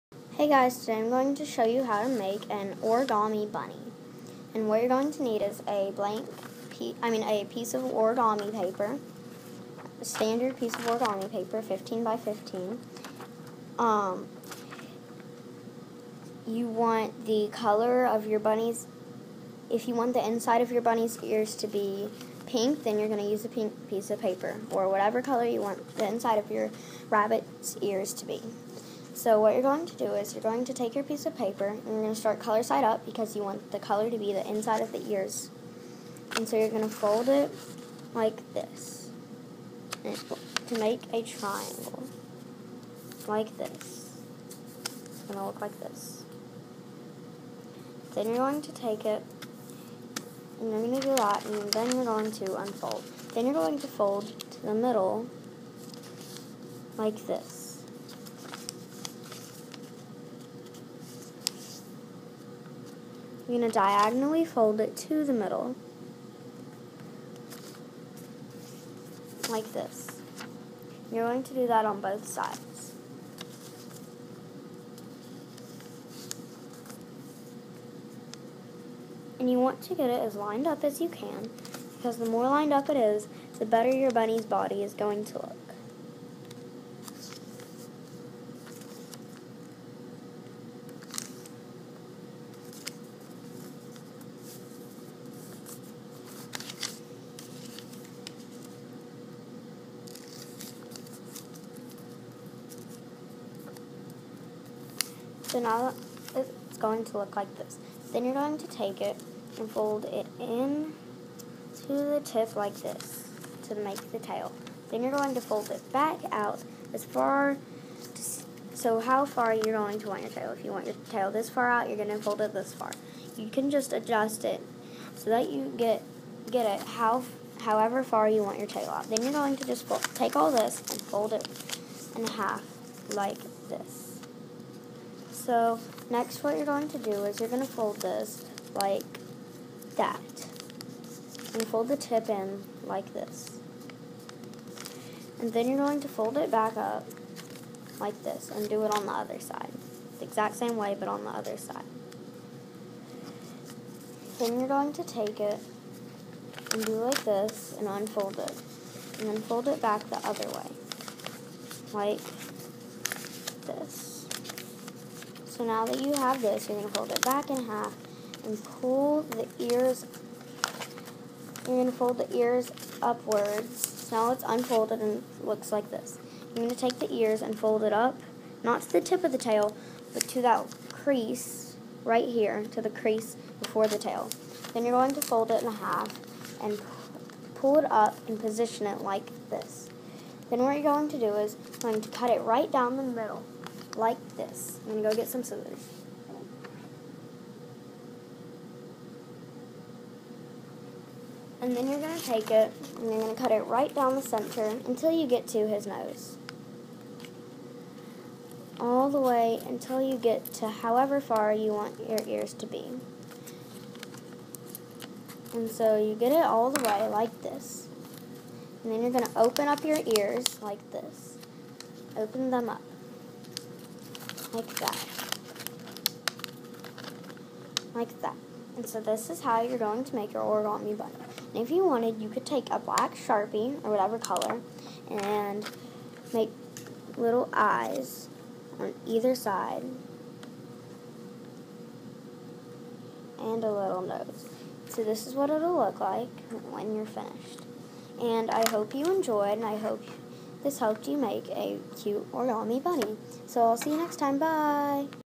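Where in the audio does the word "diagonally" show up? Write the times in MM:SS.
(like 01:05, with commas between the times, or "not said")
01:03.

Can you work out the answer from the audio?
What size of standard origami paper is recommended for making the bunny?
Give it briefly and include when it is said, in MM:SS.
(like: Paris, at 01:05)
15 by 15, at 00:11.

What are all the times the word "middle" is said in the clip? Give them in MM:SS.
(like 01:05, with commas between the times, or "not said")
00:54, 01:05, 03:13.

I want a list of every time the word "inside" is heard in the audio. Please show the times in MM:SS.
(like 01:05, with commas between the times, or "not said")
00:20, 00:26, 00:34.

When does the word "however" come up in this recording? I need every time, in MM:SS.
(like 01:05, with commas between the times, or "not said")
02:07, 03:30.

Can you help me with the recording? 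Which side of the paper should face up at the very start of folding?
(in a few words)
color side up.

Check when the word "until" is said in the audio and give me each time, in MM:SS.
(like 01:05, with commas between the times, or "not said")
03:24, 03:29.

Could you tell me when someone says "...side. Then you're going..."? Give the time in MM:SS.
02:31.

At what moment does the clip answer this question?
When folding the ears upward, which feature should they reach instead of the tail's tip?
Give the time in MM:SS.
03:02.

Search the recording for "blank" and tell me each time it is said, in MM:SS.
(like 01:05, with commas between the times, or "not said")
00:05.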